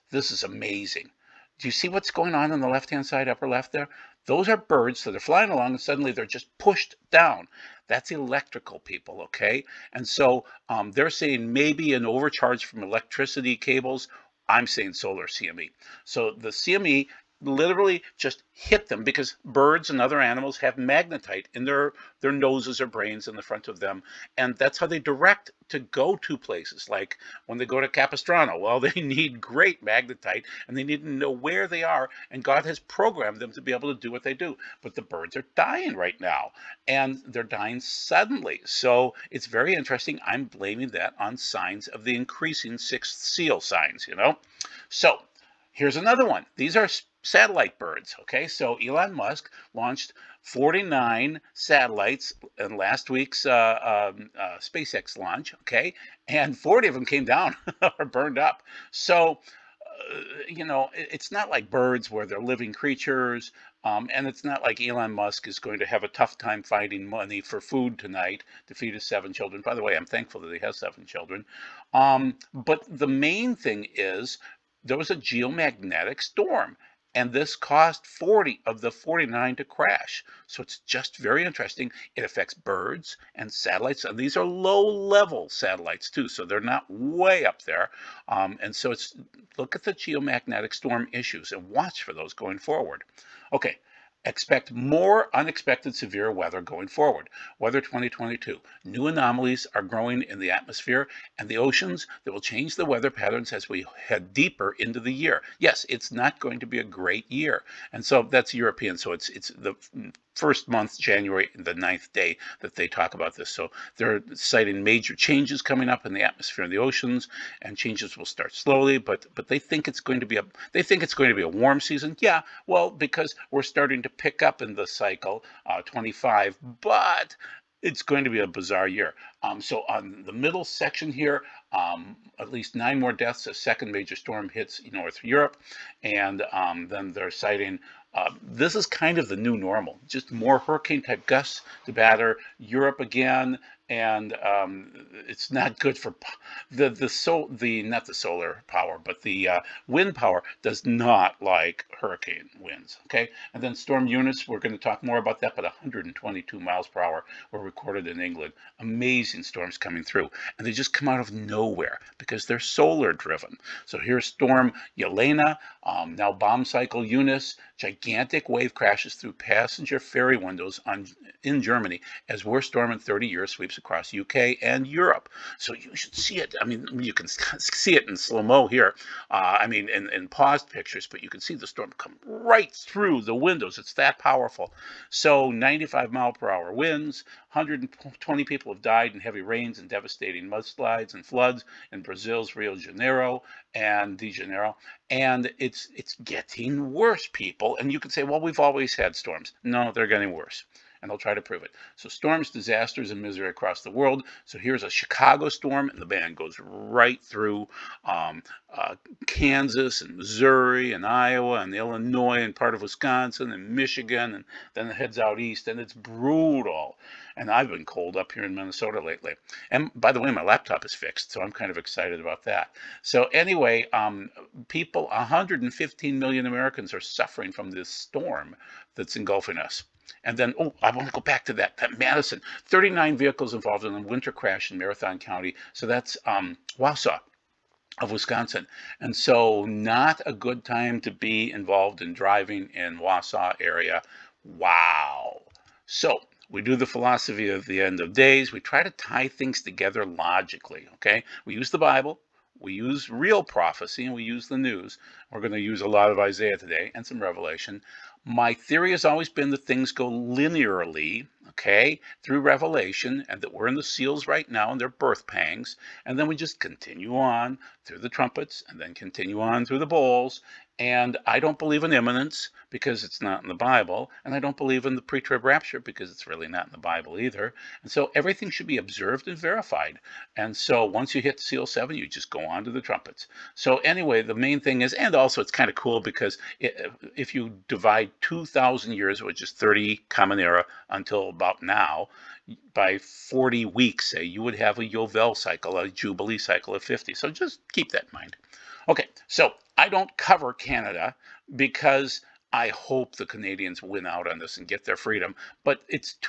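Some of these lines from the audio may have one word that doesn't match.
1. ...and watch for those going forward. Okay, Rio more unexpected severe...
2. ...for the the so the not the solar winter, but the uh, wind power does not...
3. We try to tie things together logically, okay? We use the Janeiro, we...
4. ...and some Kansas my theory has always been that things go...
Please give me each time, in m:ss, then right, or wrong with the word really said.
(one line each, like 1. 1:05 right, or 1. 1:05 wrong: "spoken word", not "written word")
1. 1:31 wrong: "Expect", not "Rio"
2. 2:25 wrong: "power", not "winter"
3. 4:08 wrong: "Bible", not "Janeiro"
4. 4:16 wrong: "Revelation", not "Kansas".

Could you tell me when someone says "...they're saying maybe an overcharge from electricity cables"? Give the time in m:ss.
0:10.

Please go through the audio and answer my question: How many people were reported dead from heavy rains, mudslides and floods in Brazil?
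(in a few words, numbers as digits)
120.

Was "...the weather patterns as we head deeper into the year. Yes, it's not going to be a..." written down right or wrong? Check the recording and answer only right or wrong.
right.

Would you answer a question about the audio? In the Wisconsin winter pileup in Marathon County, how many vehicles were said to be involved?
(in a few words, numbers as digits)
39.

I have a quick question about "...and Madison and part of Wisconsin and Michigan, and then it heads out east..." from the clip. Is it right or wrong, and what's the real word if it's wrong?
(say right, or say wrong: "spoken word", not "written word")
wrong: "Illinois", not "Madison".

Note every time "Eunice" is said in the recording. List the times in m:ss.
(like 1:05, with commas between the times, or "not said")
2:34, 2:47.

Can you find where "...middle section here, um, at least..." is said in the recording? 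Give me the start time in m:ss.
2:10.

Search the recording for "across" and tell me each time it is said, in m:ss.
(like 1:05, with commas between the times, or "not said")
2:53, 3:23.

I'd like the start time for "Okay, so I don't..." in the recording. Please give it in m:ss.
4:58.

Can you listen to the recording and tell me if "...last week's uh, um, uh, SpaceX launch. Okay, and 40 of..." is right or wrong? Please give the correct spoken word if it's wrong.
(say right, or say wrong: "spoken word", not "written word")
right.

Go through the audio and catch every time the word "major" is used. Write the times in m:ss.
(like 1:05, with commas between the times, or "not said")
1:54, 2:13.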